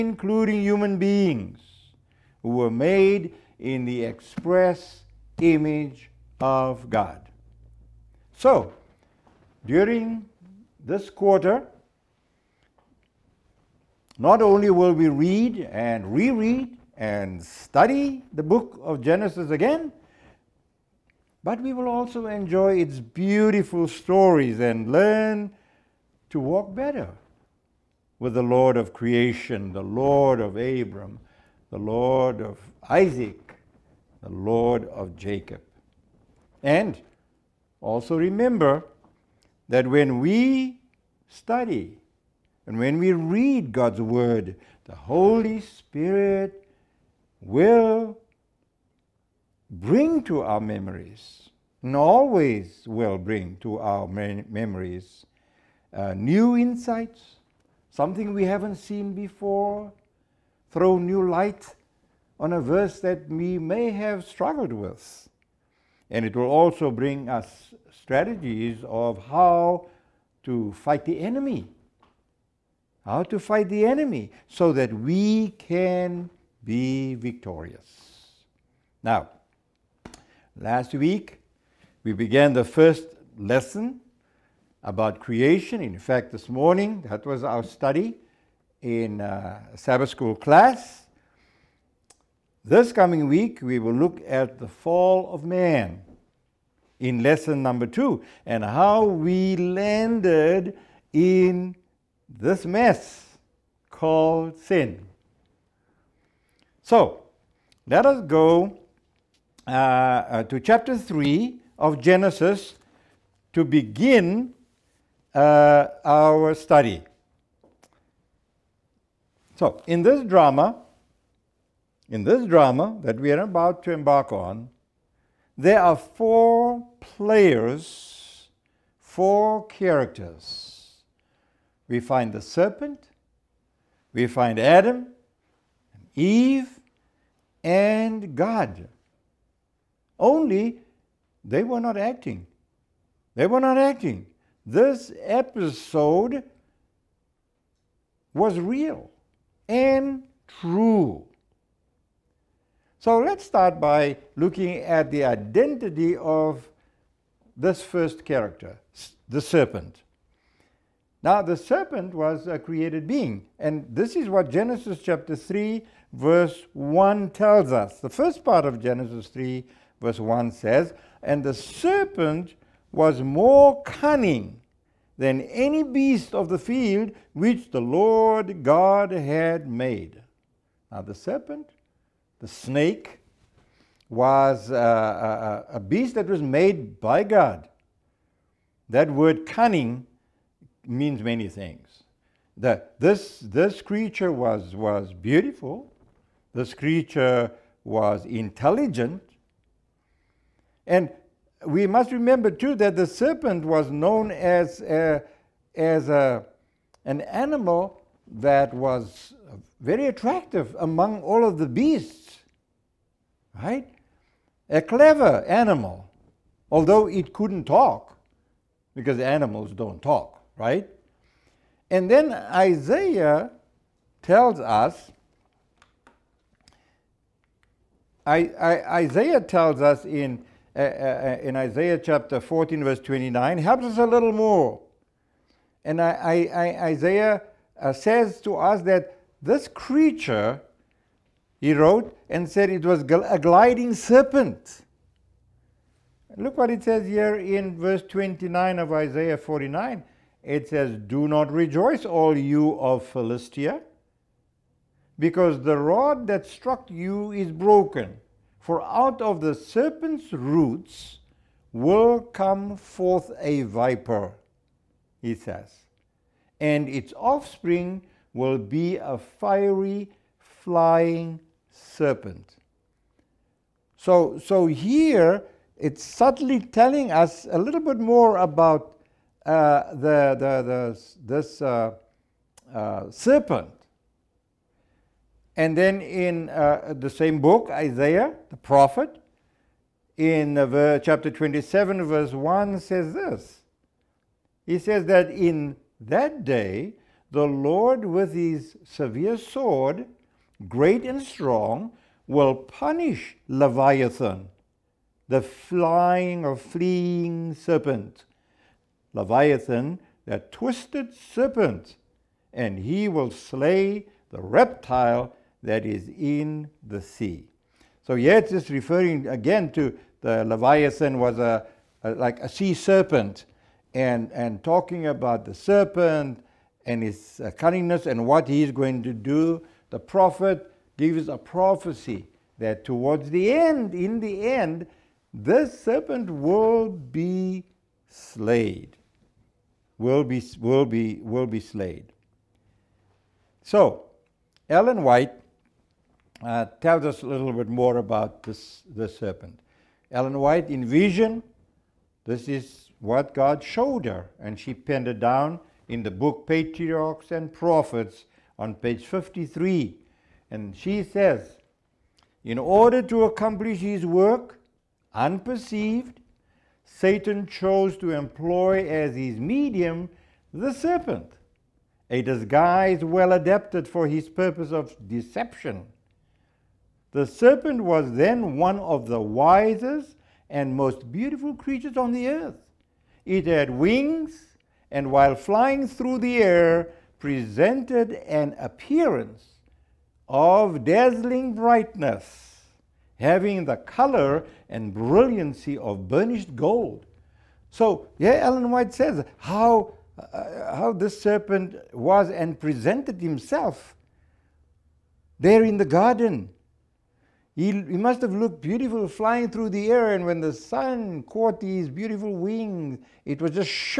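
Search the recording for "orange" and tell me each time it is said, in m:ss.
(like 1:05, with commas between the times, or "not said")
not said.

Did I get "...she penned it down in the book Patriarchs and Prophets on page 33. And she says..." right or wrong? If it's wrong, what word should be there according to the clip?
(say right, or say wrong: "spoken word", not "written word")
wrong: "53", not "33".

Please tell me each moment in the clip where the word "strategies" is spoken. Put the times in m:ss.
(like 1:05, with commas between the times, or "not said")
1:08.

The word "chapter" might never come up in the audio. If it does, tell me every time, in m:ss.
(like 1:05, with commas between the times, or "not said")
1:50, 2:45, 3:51, 4:50.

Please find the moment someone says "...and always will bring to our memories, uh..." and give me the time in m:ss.
0:51.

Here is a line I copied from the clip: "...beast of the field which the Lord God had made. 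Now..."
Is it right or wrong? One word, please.
right.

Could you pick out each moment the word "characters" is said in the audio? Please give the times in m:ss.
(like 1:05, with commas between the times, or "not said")
2:09, 2:38.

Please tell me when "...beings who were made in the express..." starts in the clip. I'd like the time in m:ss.
0:00.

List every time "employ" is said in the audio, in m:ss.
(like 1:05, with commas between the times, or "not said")
6:08.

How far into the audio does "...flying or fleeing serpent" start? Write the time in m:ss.
5:05.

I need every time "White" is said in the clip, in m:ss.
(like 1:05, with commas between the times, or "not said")
5:45, 5:50, 6:38.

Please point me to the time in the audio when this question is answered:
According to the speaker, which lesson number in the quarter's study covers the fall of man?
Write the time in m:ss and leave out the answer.
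1:37.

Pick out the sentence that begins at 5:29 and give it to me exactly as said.
The prophet gives a prophecy that towards the end, in the end, this serpent will be slayed.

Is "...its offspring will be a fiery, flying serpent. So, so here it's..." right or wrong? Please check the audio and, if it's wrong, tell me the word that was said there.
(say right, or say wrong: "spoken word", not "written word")
right.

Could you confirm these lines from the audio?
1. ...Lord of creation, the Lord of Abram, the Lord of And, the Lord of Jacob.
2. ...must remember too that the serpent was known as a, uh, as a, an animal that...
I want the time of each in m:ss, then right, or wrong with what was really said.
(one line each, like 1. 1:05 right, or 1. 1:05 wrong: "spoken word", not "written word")
1. 0:28 wrong: "Isaac", not "And"
2. 3:21 right.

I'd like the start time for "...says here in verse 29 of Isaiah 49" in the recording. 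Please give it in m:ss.
4:06.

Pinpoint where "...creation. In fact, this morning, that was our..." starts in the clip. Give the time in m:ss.
1:25.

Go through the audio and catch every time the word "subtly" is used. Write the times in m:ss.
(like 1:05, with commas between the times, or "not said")
4:36.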